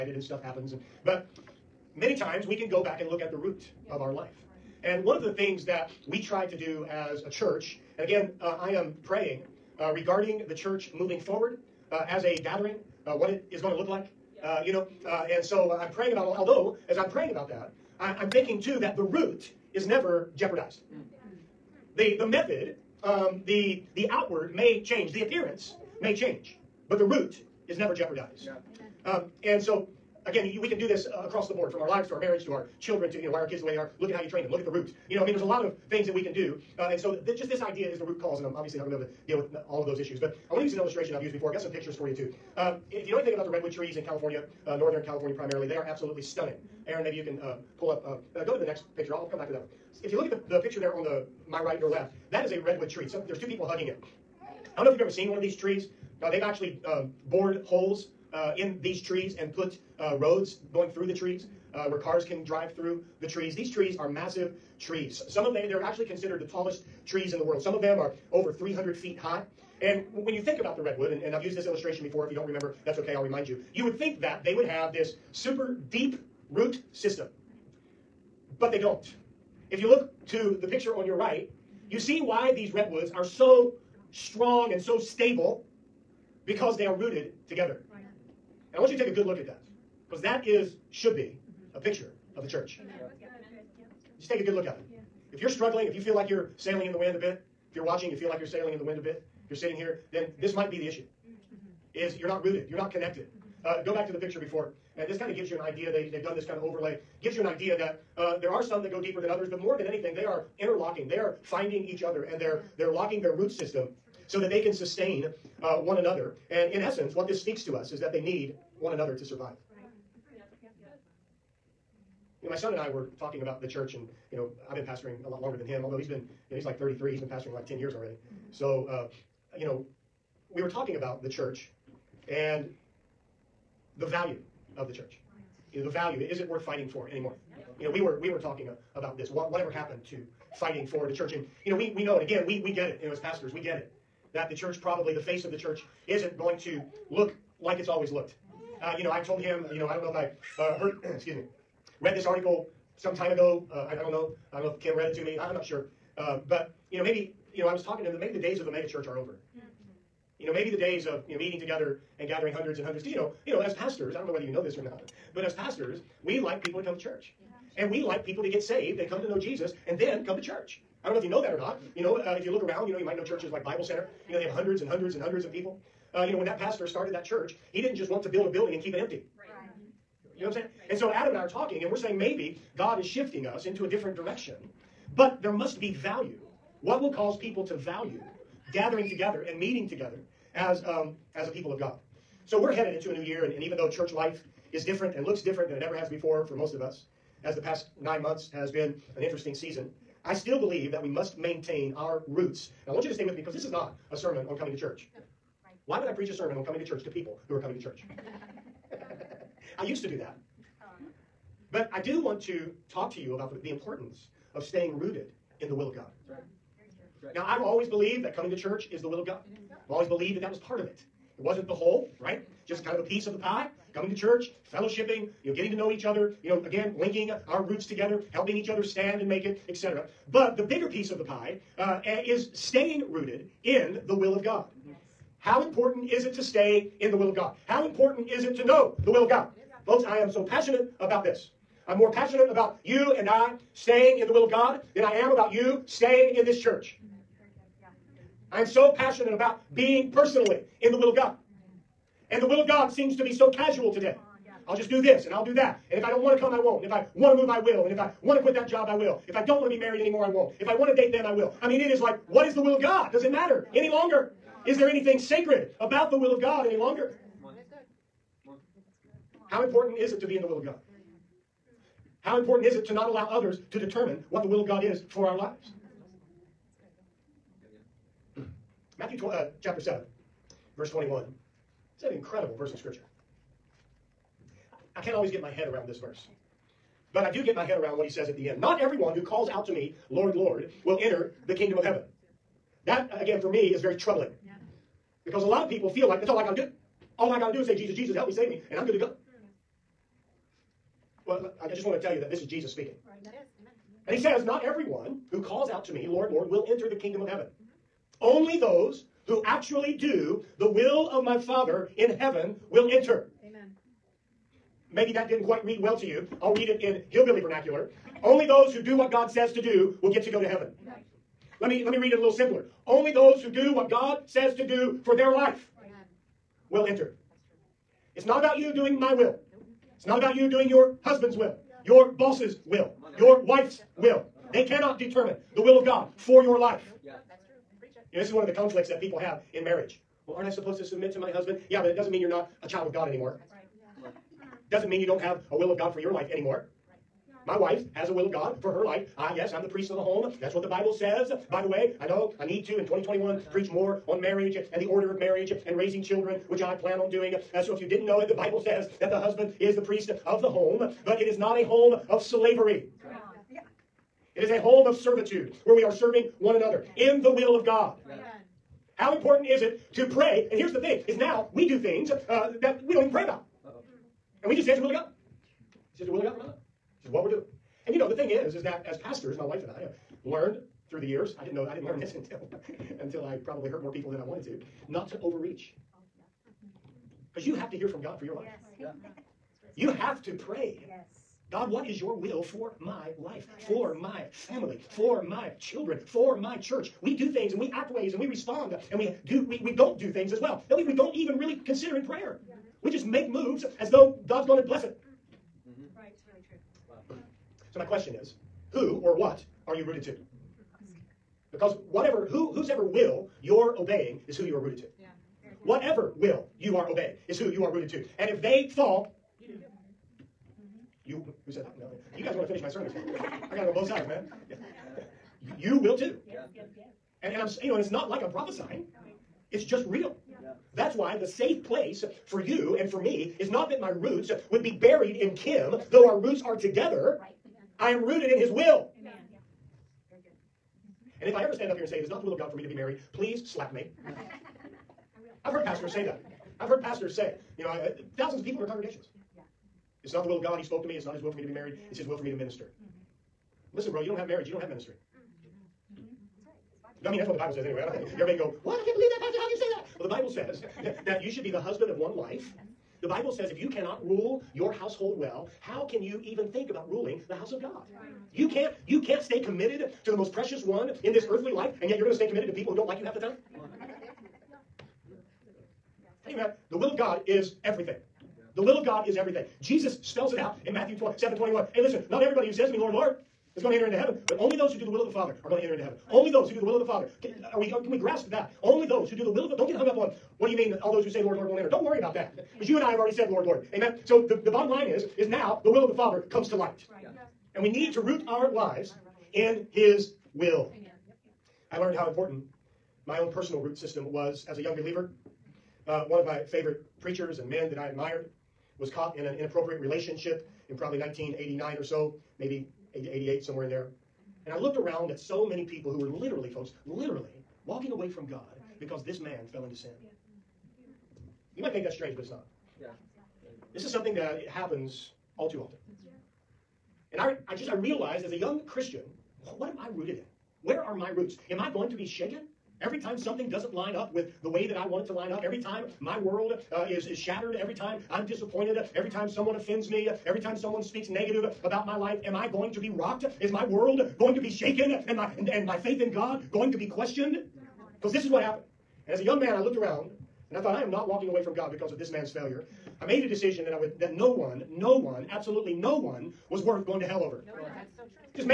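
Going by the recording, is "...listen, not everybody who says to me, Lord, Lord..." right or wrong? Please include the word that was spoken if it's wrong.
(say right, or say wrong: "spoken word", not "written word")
right.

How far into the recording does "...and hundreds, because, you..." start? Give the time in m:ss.
2:42.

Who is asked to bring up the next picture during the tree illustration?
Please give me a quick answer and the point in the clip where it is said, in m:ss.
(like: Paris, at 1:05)
Aaron, at 0:46.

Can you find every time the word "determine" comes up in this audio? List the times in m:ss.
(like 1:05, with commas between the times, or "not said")
4:33, 5:34.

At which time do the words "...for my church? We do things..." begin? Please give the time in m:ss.
6:36.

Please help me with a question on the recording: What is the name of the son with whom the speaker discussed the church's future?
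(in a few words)
Adam.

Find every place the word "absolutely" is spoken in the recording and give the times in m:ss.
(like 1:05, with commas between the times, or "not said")
0:45, 9:15.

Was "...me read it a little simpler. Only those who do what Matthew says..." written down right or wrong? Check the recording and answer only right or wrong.
wrong.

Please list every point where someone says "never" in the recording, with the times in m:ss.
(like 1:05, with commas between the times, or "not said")
0:19, 0:27.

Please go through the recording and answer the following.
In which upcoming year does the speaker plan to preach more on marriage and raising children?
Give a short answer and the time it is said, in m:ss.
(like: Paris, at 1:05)
2021, at 5:52.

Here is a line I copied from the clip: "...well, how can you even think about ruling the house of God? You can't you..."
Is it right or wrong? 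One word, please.
right.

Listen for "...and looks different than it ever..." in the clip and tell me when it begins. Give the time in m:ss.
3:15.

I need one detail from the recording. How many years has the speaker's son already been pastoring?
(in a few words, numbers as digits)
10.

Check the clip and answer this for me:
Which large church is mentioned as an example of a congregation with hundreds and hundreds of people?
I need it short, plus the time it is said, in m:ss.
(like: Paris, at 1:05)
Bible Center, at 2:53.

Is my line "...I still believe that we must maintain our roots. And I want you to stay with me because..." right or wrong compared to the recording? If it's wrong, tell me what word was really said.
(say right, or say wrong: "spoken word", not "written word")
right.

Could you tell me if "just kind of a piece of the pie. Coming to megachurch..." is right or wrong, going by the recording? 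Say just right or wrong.
wrong.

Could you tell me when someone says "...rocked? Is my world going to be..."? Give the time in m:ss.
9:02.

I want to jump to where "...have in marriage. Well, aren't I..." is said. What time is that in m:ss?
5:39.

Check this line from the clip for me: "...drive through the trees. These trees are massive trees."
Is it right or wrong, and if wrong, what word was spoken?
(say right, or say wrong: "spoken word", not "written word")
right.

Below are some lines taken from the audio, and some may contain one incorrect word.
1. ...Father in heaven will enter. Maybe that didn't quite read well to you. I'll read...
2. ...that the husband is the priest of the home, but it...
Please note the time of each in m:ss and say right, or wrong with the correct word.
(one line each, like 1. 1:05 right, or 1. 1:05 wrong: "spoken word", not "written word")
1. 5:11 right
2. 5:59 right.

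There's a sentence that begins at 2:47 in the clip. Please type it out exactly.
And we like people to get saved and come to know Jesus and then come to church.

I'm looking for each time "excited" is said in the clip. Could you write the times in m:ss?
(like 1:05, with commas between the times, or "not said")
not said.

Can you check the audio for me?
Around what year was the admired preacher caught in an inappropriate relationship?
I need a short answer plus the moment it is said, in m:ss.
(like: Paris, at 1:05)
1989, at 8:30.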